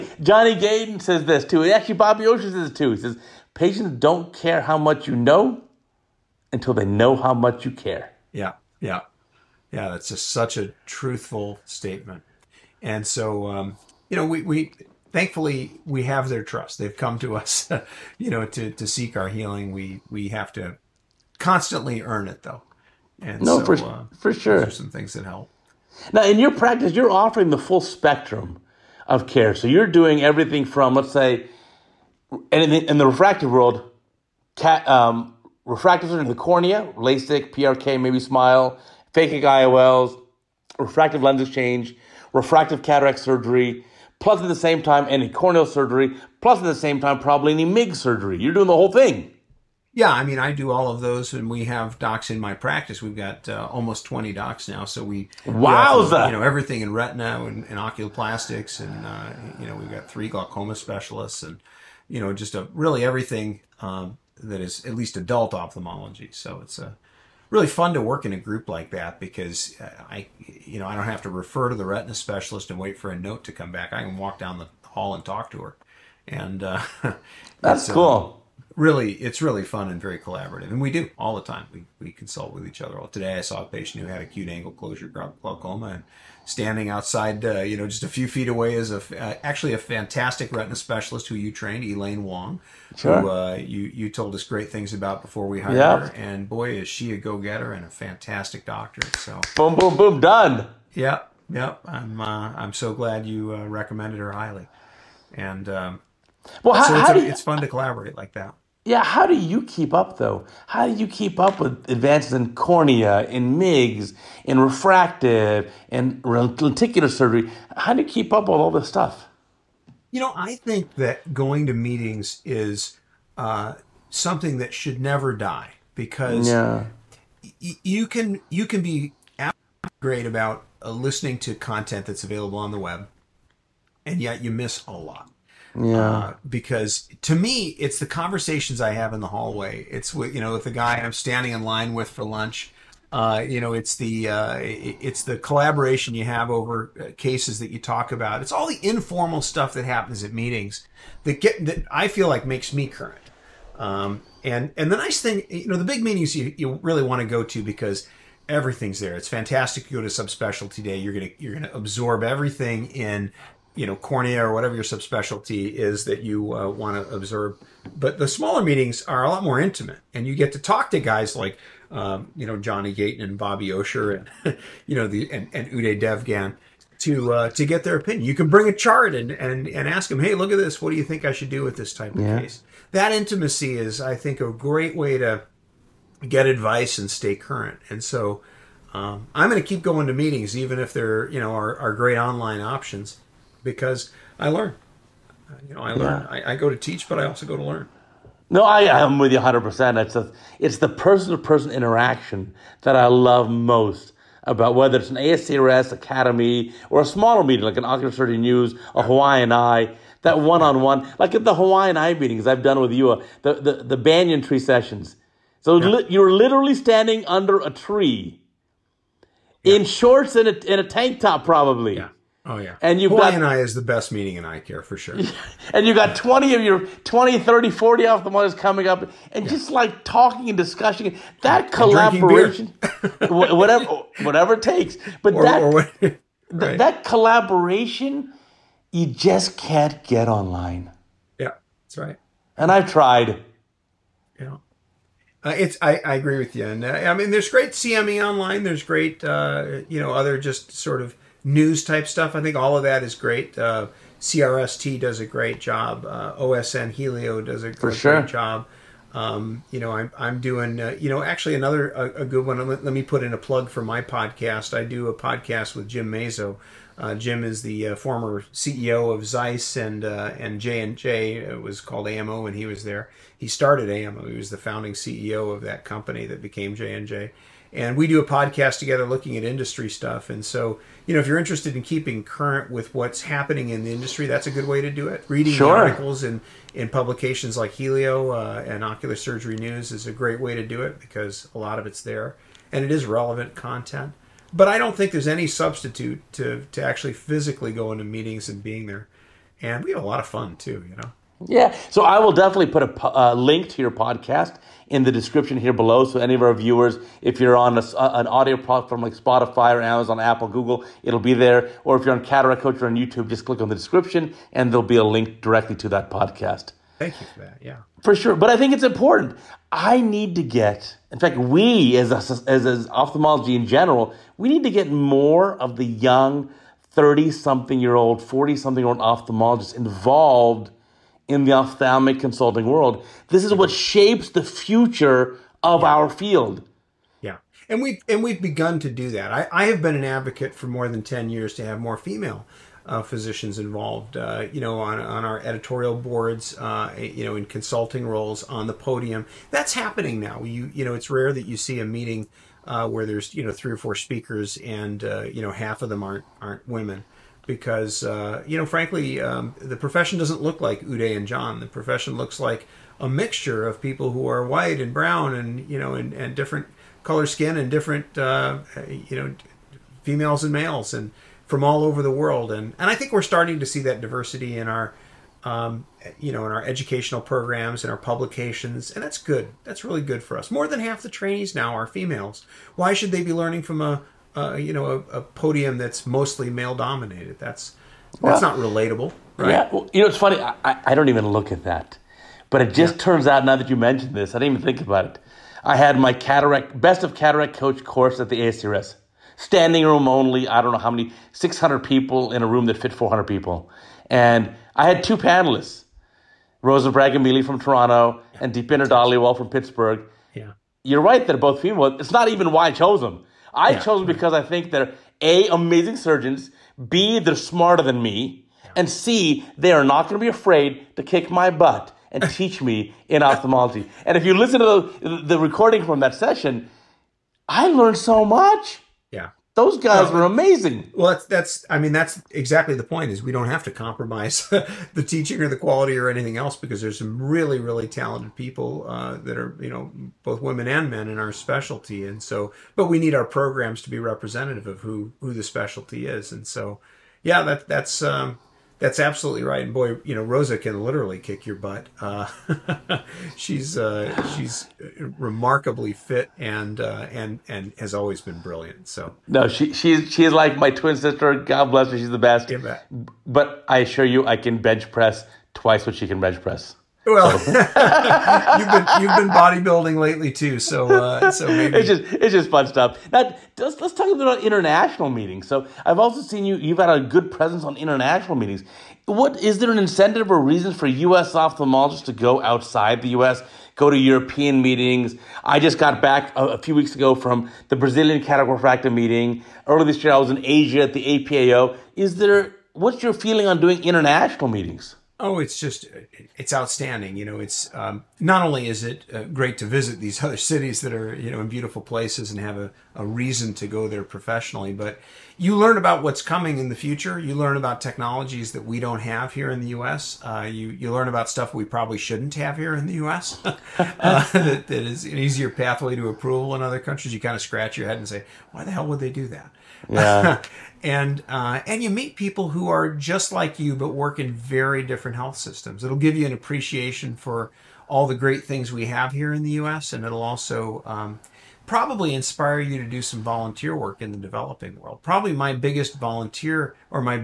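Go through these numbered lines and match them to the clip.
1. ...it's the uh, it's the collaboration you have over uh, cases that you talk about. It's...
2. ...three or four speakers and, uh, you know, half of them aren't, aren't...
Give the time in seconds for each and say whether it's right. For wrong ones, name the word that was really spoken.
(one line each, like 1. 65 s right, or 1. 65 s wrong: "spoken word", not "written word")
1. 143 s right
2. 353 s right.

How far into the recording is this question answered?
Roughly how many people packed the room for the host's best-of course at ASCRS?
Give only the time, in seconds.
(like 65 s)
401 s.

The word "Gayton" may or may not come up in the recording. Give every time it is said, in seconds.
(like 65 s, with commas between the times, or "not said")
0 s, 172 s.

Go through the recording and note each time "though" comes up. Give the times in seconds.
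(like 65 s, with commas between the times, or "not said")
22 s, 110 s.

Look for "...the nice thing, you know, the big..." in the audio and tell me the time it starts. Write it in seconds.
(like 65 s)
154 s.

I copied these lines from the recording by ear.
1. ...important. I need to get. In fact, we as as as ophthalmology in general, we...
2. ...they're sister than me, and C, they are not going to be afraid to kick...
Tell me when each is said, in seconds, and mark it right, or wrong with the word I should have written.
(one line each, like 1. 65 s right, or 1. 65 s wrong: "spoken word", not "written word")
1. 318 s right
2. 417 s wrong: "smarter", not "sister".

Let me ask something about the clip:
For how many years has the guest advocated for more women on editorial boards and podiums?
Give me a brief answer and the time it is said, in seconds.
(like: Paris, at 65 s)
more than 10 years, at 340 s.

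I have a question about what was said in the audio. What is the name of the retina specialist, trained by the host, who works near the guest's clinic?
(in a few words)
Elaine Wong.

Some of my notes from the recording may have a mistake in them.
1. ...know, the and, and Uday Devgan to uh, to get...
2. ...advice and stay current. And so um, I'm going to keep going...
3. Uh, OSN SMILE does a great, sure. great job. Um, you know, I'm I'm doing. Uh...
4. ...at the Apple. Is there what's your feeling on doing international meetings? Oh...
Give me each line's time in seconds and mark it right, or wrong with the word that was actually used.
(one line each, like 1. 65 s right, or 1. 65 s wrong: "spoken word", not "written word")
1. 174 s right
2. 186 s right
3. 256 s wrong: "Healio", not "SMILE"
4. 490 s wrong: "APAO", not "Apple".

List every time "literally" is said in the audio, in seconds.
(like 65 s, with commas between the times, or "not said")
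216 s, 450 s.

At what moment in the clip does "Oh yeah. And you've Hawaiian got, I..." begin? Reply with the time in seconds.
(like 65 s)
222 s.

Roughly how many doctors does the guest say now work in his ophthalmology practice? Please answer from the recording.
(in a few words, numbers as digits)
almost 20.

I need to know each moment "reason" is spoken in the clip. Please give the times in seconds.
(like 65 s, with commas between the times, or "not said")
480 s, 503 s.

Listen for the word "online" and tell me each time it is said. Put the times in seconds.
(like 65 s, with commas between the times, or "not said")
192 s, 240 s, 248 s.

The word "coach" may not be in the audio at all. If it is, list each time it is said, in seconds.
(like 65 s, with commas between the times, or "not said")
312 s, 397 s.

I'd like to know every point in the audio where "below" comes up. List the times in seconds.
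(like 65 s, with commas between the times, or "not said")
305 s.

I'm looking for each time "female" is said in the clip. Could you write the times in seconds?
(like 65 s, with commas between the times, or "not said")
341 s, 370 s, 381 s, 411 s.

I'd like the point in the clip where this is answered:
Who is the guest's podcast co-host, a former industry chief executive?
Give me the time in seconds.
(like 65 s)
265 s.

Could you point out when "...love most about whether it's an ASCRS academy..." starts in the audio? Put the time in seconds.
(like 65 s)
203 s.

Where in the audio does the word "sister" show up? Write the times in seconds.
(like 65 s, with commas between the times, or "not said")
460 s.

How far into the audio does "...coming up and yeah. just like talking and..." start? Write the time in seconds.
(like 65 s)
228 s.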